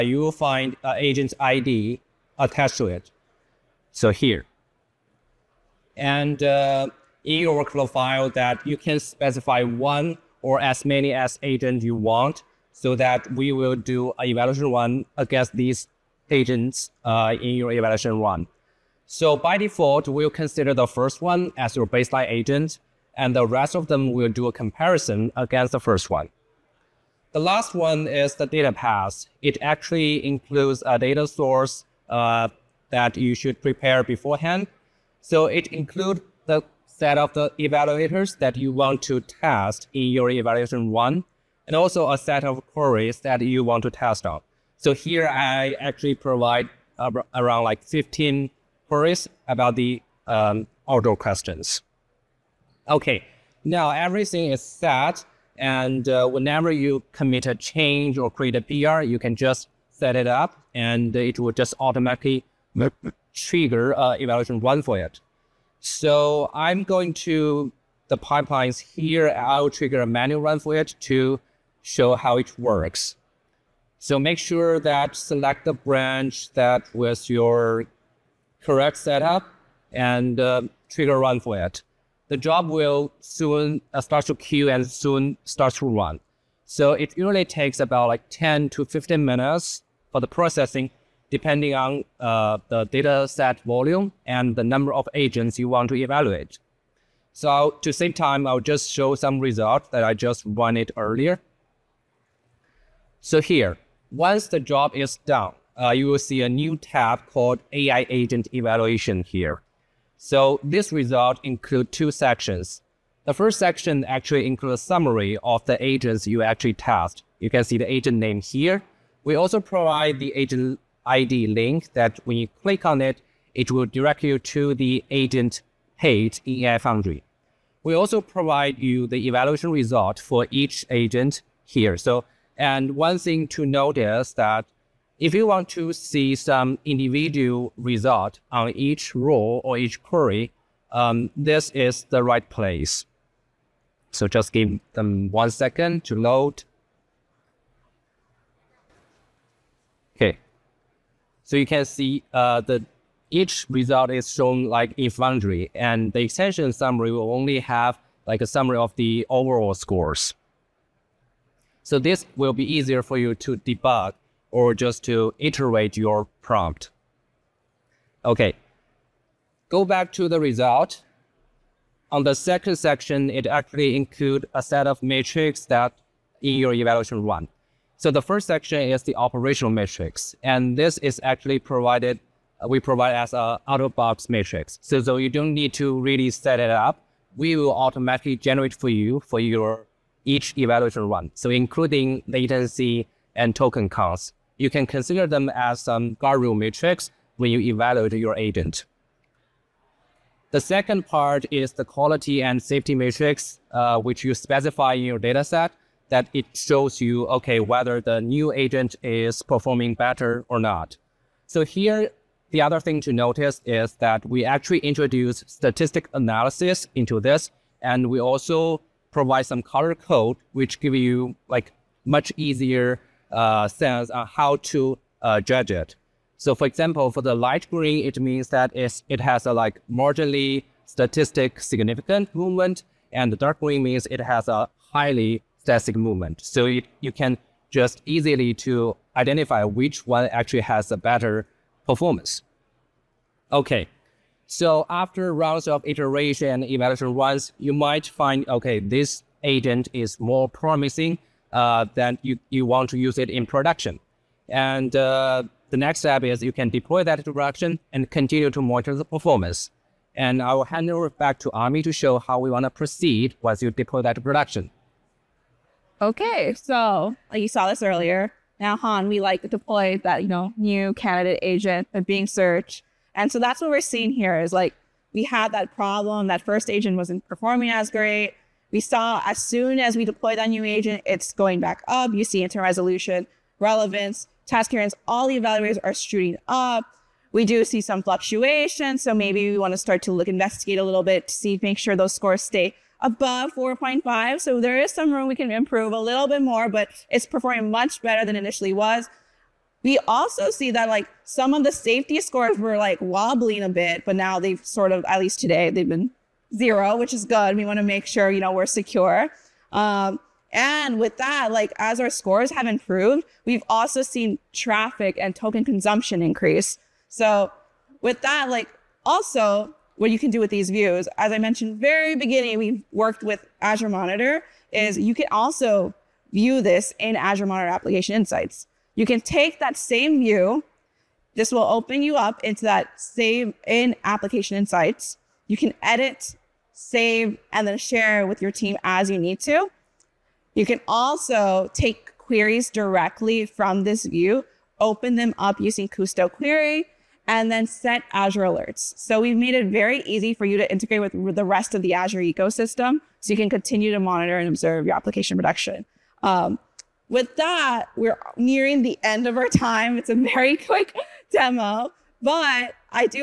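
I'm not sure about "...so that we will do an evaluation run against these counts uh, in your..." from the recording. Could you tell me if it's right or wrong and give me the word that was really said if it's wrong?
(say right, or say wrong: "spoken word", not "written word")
wrong: "agents", not "counts".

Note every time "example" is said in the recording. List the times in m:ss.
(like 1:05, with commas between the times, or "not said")
3:46.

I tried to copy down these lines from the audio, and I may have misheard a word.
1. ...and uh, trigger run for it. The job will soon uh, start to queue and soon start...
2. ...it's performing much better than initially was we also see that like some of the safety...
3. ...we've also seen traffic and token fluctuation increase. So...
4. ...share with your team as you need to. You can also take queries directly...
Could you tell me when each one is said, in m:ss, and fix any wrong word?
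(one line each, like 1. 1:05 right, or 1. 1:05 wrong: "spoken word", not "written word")
1. 1:19 right
2. 4:57 right
3. 5:13 wrong: "consumption", not "fluctuation"
4. 5:37 right.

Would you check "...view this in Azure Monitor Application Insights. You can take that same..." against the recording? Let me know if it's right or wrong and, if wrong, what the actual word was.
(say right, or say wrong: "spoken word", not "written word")
right.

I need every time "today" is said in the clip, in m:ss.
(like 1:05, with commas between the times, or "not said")
5:05.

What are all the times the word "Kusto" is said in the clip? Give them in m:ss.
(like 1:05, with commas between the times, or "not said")
5:45.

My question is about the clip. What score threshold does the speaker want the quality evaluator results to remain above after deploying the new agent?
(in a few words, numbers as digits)
4.5.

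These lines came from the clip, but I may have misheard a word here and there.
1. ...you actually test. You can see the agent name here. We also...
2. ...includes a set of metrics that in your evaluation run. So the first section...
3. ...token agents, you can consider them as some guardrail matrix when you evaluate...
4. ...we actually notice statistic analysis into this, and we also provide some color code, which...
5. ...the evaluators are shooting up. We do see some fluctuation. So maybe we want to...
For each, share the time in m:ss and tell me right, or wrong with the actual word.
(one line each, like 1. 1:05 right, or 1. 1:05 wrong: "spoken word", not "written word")
1. 1:56 right
2. 2:53 right
3. 3:13 wrong: "counts", not "agents"
4. 3:34 wrong: "introduce", not "notice"
5. 4:45 right.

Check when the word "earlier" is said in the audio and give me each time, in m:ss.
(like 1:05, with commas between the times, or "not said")
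1:40, 4:27.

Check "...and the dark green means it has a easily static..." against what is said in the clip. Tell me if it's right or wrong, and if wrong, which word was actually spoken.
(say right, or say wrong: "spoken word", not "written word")
wrong: "highly", not "easily".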